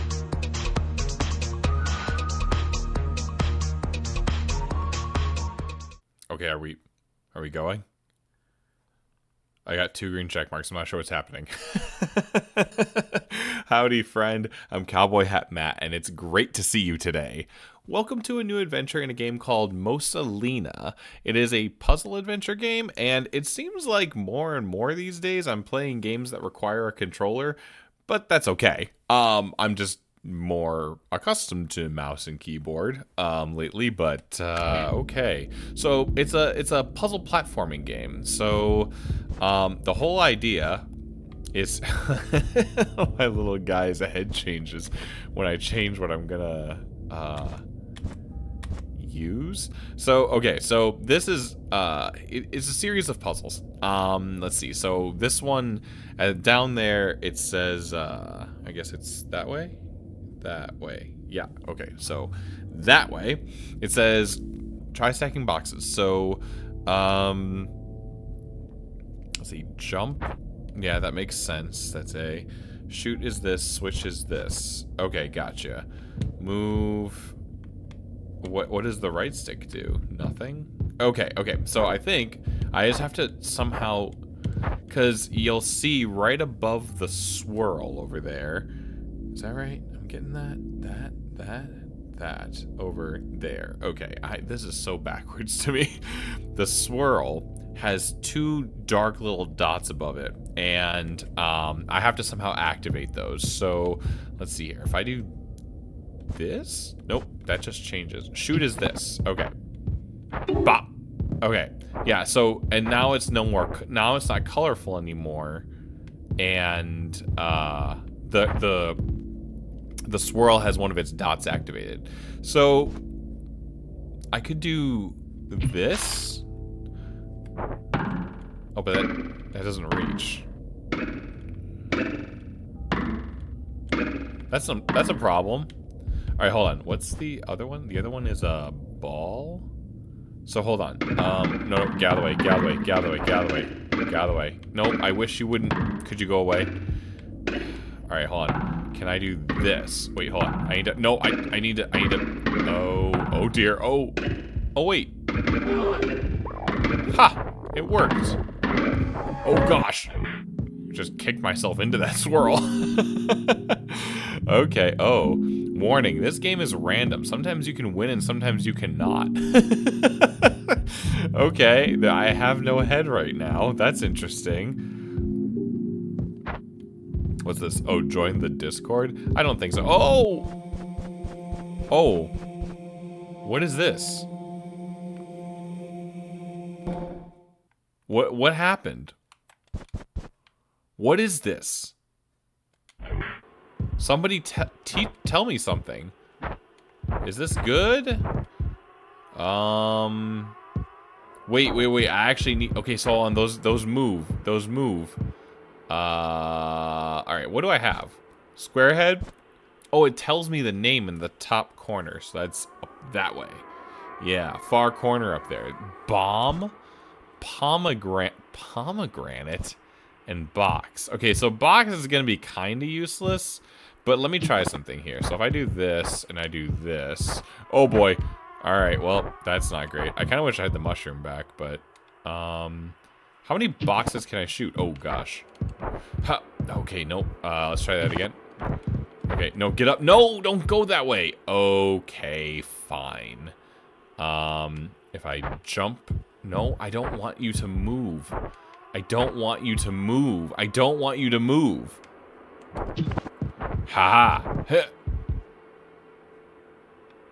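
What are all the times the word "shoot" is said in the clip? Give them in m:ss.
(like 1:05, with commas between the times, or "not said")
1:12, 1:48, 3:54.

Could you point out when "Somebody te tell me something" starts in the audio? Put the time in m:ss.
3:13.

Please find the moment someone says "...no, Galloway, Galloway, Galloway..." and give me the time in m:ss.
2:21.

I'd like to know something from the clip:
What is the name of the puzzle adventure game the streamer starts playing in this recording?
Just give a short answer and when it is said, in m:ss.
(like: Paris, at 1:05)
Mosa Lina, at 0:19.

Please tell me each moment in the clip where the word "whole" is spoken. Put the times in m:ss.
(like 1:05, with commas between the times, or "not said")
0:39.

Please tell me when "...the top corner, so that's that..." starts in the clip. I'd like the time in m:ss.
3:31.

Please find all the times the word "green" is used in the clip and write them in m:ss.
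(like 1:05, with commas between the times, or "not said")
0:10.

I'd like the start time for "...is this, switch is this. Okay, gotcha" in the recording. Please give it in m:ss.
1:13.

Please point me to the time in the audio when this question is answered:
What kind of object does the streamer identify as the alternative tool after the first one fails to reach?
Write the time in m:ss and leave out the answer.
2:17.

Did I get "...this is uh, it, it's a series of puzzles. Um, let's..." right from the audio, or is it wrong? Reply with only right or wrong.
right.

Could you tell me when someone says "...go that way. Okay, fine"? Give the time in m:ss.
4:00.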